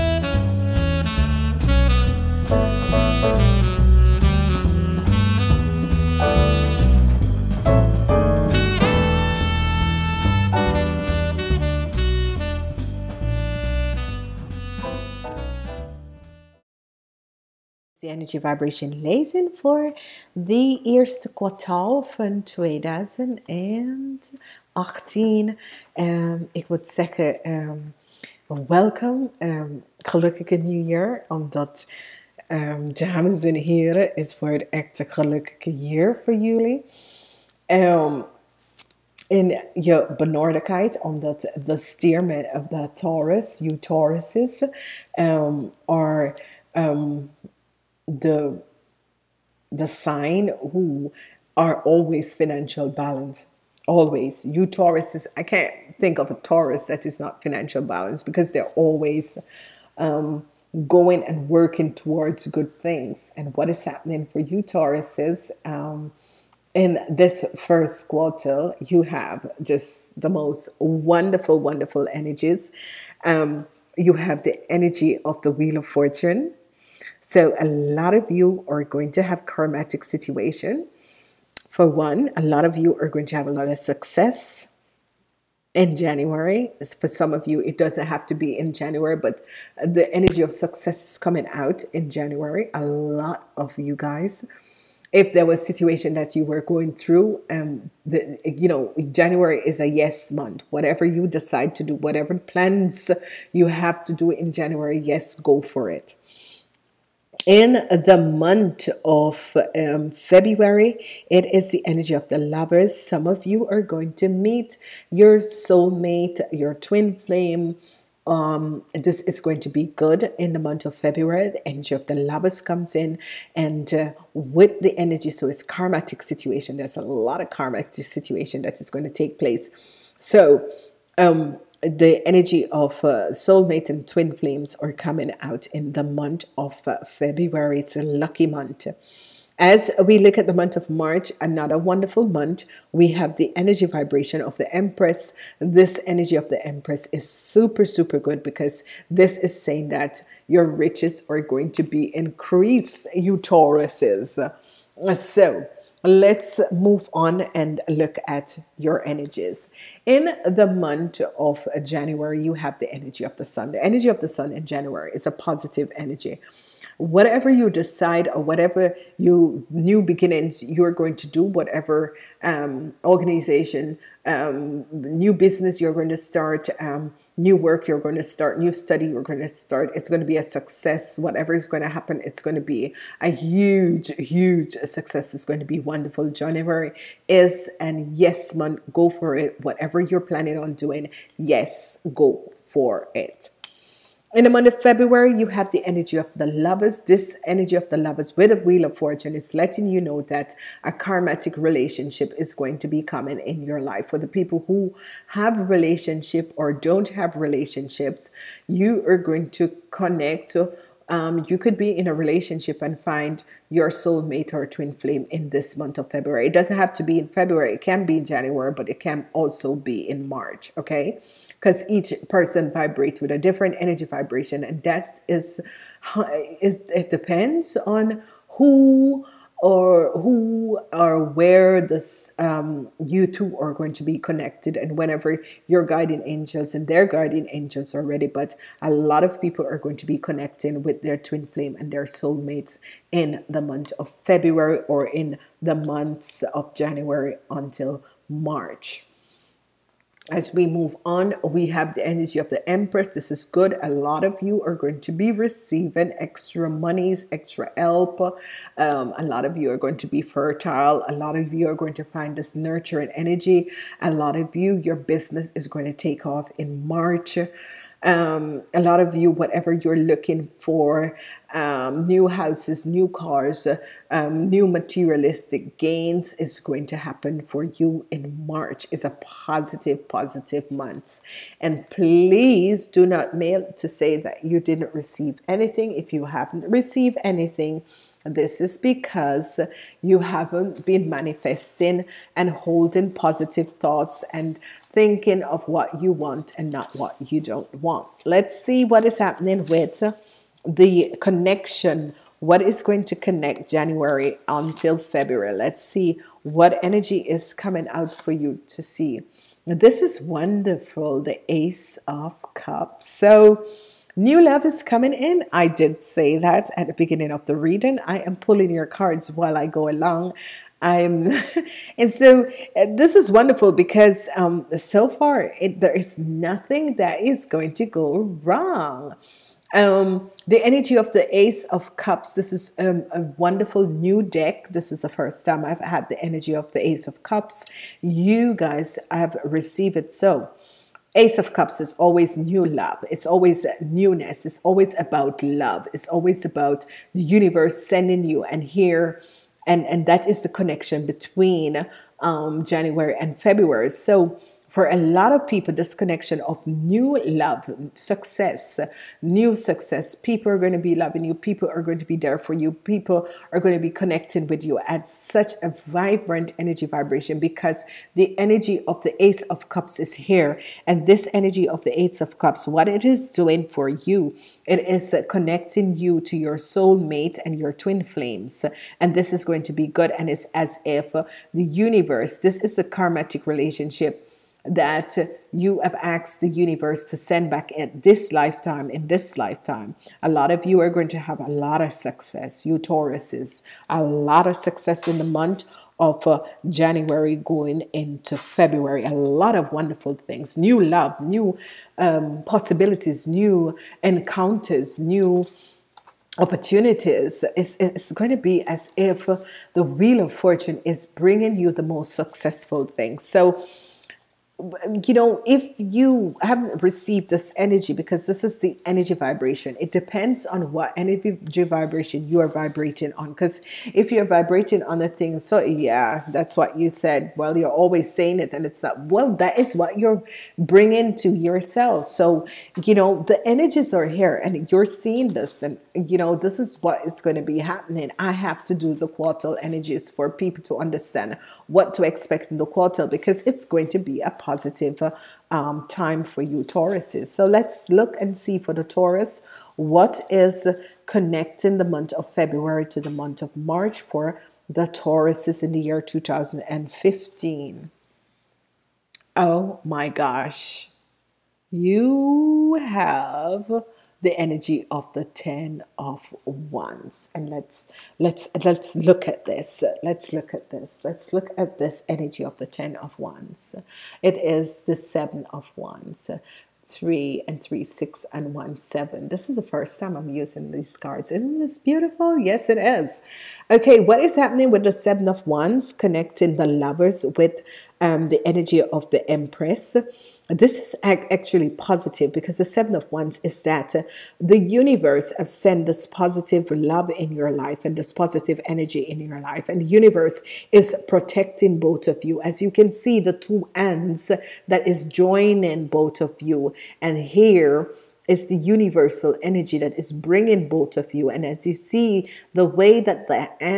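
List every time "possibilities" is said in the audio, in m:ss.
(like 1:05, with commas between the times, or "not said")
6:42.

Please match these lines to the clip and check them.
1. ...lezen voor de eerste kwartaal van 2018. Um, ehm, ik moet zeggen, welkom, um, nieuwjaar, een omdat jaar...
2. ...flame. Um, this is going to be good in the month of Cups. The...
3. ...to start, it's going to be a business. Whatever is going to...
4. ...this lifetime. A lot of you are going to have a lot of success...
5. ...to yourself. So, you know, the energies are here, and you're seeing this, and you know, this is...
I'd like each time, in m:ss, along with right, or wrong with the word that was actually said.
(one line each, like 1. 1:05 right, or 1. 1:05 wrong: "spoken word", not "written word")
1. 0:19 right
2. 1:57 wrong: "February", not "Cups"
3. 2:59 wrong: "success", not "business"
4. 6:29 right
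5. 7:11 right.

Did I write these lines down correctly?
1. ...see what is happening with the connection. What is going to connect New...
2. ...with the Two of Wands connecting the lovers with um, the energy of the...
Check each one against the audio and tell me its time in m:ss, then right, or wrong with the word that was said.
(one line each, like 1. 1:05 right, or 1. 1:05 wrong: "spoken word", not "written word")
1. 4:58 wrong: "January", not "New"
2. 8:04 wrong: "Seven", not "Two".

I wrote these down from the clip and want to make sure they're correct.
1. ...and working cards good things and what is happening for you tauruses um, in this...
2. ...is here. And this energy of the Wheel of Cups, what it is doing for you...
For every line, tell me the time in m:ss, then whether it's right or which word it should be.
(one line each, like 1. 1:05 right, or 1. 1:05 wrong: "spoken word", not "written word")
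1. 1:01 wrong: "towards", not "cards"
2. 6:09 wrong: "Ace", not "Wheel".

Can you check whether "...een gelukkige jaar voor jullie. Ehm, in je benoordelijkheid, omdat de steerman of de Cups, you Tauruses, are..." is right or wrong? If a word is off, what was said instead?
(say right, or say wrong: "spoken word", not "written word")
wrong: "Taurus", not "Cups".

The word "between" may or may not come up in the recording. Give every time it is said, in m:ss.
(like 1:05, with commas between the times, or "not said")
5:51.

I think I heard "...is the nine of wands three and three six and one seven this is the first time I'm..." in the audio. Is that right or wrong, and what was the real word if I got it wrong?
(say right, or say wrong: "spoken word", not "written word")
wrong: "seven", not "nine".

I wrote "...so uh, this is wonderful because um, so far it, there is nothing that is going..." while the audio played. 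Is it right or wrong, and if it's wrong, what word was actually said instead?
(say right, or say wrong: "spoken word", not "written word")
right.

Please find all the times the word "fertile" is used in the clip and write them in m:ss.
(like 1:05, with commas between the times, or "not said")
4:20.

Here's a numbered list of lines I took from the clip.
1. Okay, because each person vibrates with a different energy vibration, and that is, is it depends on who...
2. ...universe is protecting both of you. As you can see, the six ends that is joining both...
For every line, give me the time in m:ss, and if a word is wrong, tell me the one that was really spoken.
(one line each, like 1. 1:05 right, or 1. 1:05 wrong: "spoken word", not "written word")
1. 3:40 right
2. 8:19 wrong: "two", not "six".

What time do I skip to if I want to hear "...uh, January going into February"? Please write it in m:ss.
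6:36.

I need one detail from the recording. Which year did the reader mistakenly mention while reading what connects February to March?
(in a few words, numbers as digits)
2015.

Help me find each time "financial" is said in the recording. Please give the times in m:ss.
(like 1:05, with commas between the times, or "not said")
0:52, 0:57.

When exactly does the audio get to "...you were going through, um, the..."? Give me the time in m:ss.
1:36.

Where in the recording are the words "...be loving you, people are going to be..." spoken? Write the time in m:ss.
6:00.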